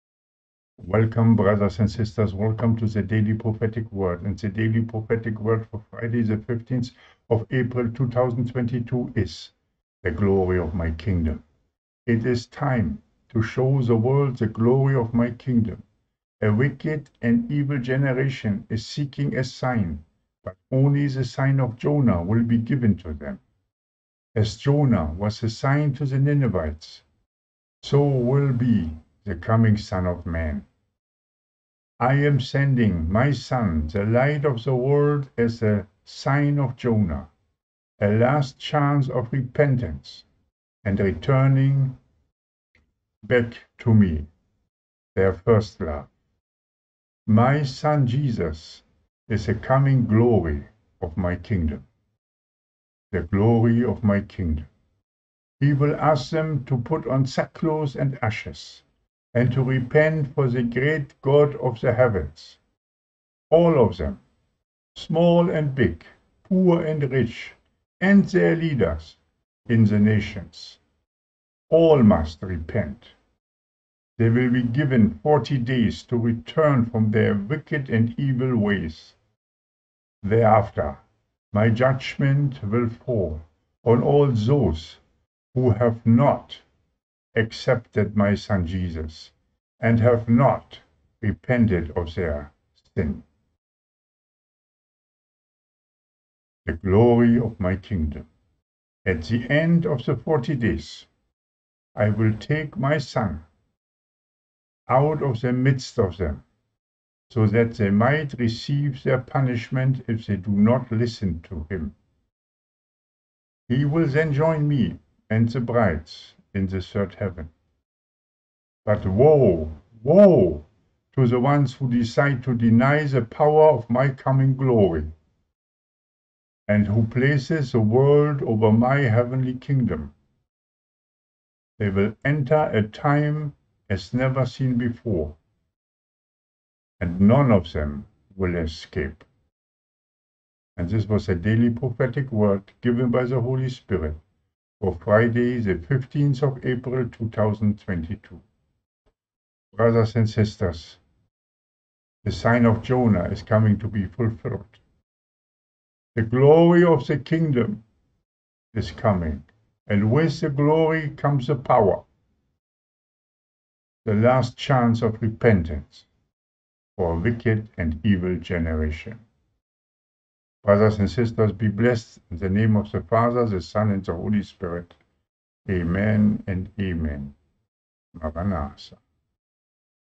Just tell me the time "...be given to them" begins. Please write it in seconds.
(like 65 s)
22 s.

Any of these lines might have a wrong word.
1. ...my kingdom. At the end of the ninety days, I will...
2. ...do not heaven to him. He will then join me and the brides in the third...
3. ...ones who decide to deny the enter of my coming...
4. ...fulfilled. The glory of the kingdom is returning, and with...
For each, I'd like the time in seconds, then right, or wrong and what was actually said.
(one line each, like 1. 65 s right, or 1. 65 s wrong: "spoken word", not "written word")
1. 97 s wrong: "forty", not "ninety"
2. 110 s wrong: "listen", not "heaven"
3. 121 s wrong: "power", not "enter"
4. 154 s wrong: "coming", not "returning".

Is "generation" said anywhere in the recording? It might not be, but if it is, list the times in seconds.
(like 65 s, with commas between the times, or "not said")
17 s, 168 s.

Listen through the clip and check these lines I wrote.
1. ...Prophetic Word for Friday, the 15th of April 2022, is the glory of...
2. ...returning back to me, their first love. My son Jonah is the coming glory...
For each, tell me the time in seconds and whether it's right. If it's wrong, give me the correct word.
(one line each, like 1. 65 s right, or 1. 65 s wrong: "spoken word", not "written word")
1. 4 s right
2. 40 s wrong: "Jesus", not "Jonah".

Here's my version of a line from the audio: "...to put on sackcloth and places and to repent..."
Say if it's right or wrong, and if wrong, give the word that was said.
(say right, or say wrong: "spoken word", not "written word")
wrong: "ashes", not "places".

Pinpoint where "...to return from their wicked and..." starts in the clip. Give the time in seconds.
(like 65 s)
76 s.